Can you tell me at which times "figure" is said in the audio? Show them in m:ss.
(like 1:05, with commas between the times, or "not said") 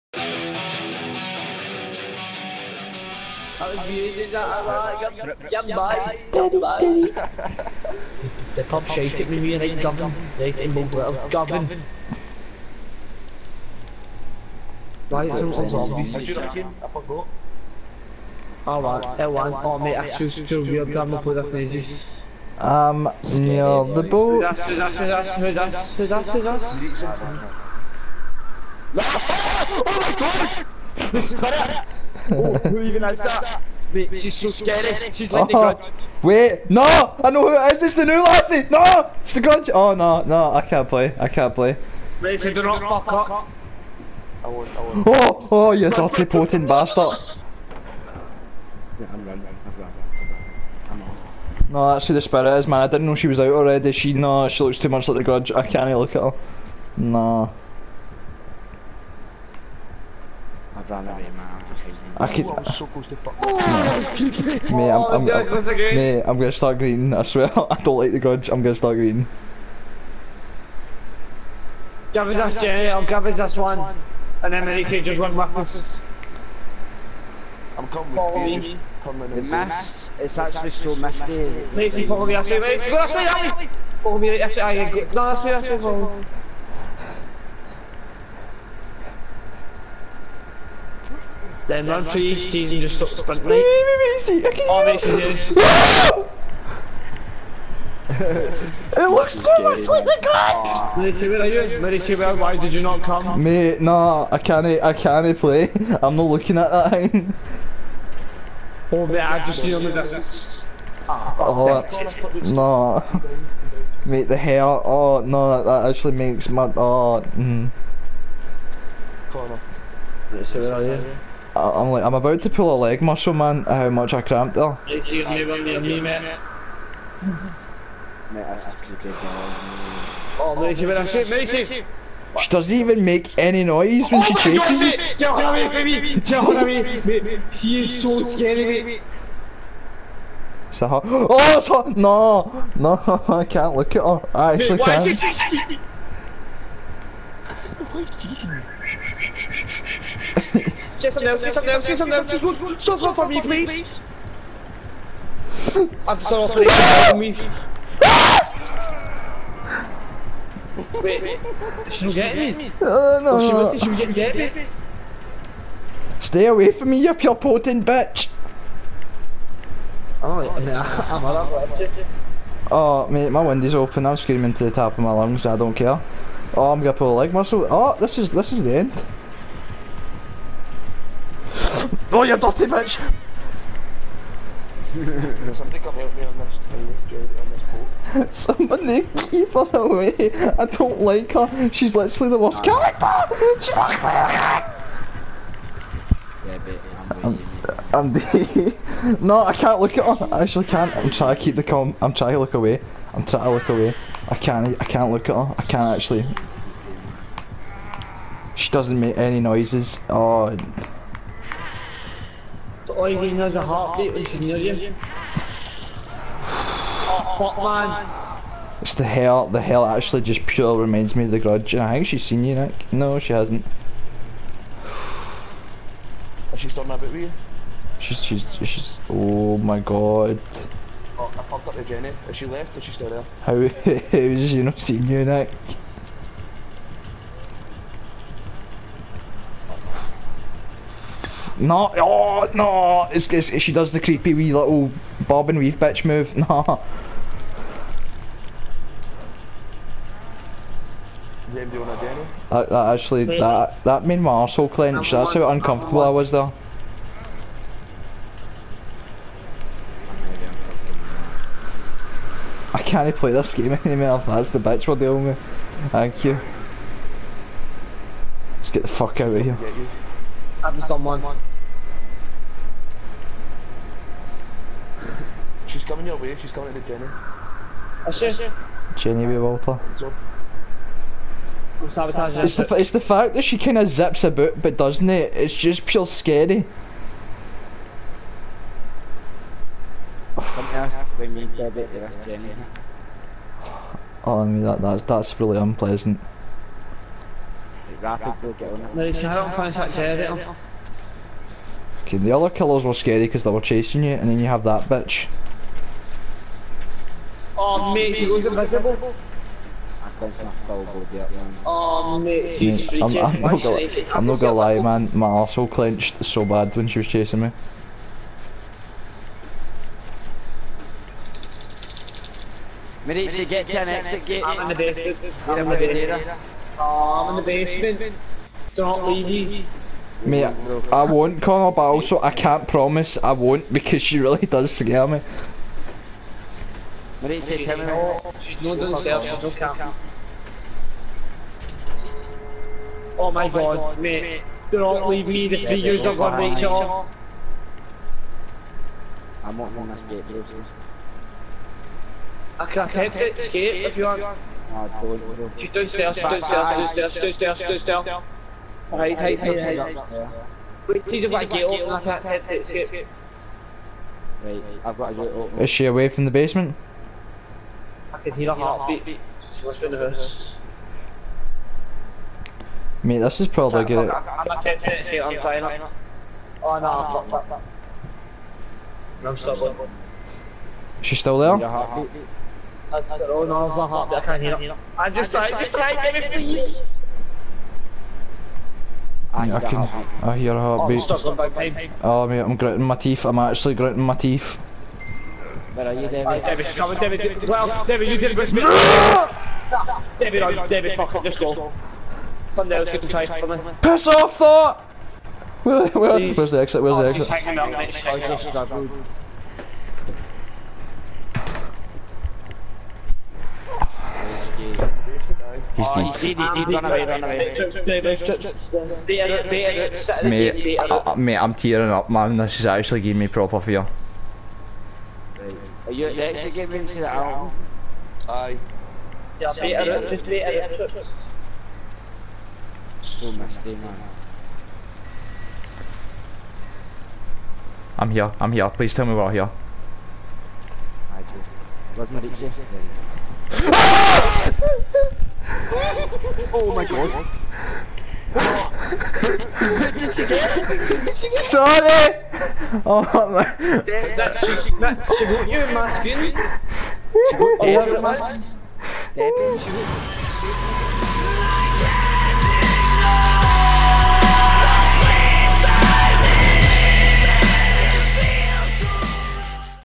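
not said.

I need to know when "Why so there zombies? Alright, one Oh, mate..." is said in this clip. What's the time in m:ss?
0:15.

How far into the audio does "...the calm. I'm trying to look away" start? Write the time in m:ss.
3:21.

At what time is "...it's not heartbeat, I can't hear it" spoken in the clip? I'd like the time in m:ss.
6:23.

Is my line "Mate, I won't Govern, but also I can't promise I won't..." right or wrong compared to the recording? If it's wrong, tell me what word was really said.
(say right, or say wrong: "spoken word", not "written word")
wrong: "Connor", not "Govern".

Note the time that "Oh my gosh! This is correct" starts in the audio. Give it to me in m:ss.
0:29.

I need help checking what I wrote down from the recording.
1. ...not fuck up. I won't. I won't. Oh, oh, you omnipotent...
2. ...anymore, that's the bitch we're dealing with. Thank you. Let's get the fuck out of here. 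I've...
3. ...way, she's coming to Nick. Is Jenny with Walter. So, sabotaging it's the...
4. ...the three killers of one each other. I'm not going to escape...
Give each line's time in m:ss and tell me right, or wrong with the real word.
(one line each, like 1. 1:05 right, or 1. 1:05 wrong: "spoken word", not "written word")
1. 0:42 right
2. 4:23 right
3. 4:36 wrong: "Jenny", not "Nick"
4. 5:45 wrong: "years", not "killers".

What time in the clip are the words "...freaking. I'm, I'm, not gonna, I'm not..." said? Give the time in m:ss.
5:12.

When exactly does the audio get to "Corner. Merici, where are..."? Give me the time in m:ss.
1:59.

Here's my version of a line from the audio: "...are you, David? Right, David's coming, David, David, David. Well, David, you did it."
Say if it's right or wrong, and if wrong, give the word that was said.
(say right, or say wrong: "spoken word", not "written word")
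right.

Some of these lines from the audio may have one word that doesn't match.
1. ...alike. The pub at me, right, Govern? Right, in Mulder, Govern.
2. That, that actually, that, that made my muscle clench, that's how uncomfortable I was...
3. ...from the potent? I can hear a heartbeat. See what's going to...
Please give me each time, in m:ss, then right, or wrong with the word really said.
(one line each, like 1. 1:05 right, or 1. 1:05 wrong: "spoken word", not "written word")
1. 0:06 right
2. 4:12 wrong: "arsehole", not "muscle"
3. 6:06 wrong: "basement", not "potent".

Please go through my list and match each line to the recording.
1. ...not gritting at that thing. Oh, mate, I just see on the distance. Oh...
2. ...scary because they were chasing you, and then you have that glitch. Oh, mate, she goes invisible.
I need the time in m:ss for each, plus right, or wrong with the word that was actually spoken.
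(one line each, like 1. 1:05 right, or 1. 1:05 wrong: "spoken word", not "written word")
1. 1:46 wrong: "looking", not "gritting"
2. 5:02 wrong: "bitch", not "glitch".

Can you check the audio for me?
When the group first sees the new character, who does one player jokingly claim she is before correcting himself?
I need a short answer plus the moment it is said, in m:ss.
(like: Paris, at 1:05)
The new Lassie, at 0:37.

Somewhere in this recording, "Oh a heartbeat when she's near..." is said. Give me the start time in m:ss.
3:30.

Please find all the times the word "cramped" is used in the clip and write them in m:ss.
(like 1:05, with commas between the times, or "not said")
2:04.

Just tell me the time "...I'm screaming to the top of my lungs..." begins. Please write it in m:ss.
2:54.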